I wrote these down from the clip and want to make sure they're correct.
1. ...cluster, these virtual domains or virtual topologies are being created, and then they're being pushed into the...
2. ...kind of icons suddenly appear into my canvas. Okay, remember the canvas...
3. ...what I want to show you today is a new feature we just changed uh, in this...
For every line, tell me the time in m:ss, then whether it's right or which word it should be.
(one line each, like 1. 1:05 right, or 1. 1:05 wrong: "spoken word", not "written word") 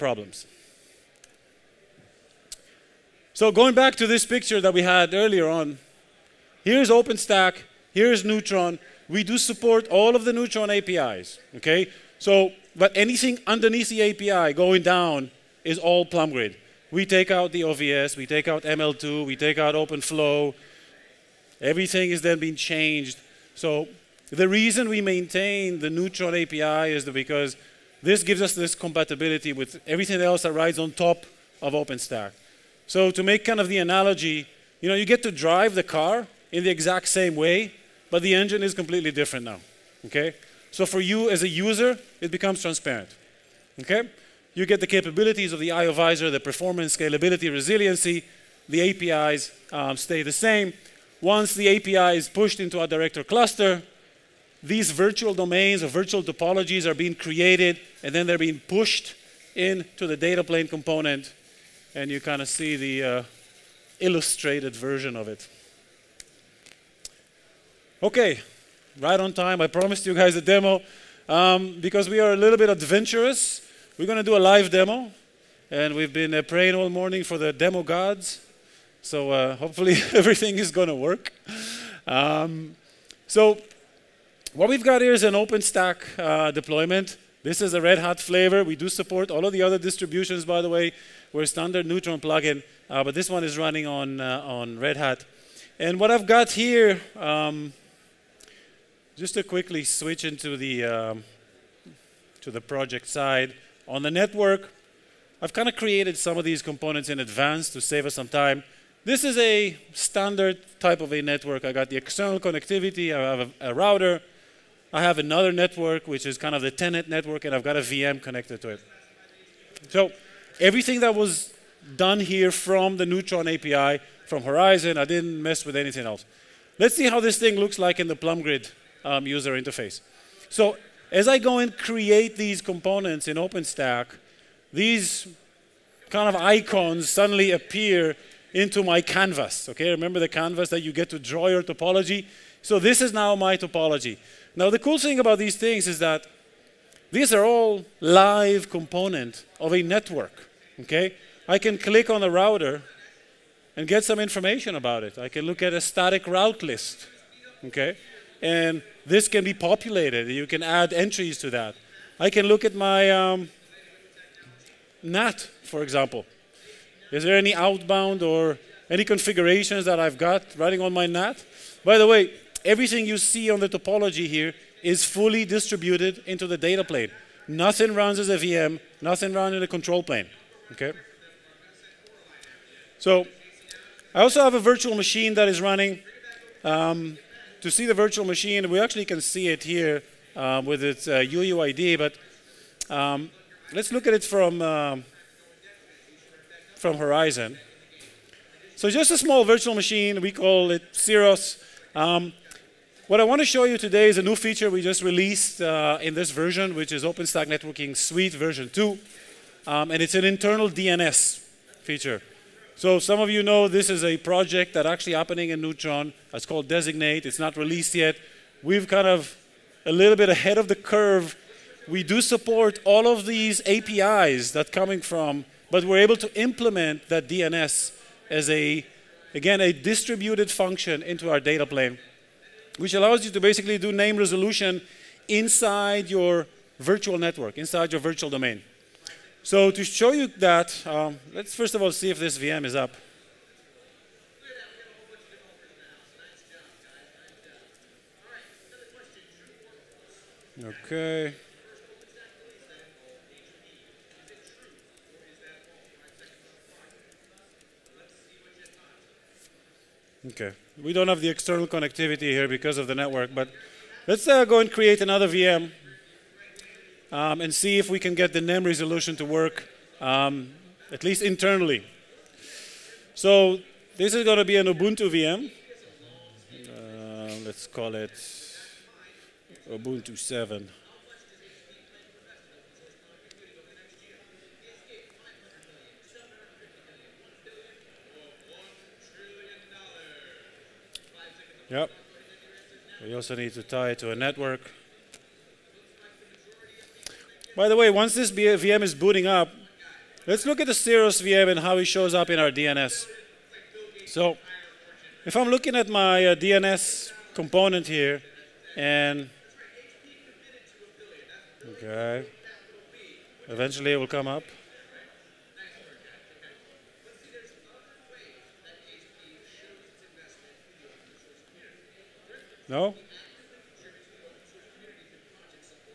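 1. 0:53 right
2. 2:16 right
3. 3:23 wrong: "released", not "changed".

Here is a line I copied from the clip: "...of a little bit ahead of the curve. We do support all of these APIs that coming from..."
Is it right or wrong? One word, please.
right.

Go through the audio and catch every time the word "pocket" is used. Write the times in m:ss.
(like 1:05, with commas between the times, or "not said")
not said.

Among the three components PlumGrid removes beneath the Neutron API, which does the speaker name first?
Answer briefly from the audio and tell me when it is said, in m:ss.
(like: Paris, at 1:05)
OVS, at 0:17.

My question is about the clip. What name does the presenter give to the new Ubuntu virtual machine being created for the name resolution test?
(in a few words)
Ubuntu 7.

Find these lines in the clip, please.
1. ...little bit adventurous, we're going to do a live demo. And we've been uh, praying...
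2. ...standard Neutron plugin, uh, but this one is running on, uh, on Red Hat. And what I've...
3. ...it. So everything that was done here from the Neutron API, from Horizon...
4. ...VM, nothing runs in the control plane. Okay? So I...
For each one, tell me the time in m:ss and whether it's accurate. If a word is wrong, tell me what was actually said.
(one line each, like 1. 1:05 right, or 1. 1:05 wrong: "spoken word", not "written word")
1. 1:12 right
2. 1:31 right
3. 1:58 right
4. 2:58 right.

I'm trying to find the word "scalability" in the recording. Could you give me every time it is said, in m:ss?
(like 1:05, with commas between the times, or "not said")
0:46.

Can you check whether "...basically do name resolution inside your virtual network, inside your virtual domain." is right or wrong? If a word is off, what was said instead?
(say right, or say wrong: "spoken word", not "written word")
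right.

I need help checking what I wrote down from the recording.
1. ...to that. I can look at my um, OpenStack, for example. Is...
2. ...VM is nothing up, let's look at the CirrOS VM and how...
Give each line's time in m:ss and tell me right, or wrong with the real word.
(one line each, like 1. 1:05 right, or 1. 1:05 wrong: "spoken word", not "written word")
1. 2:41 wrong: "NAT", not "OpenStack"
2. 4:58 wrong: "booting", not "nothing".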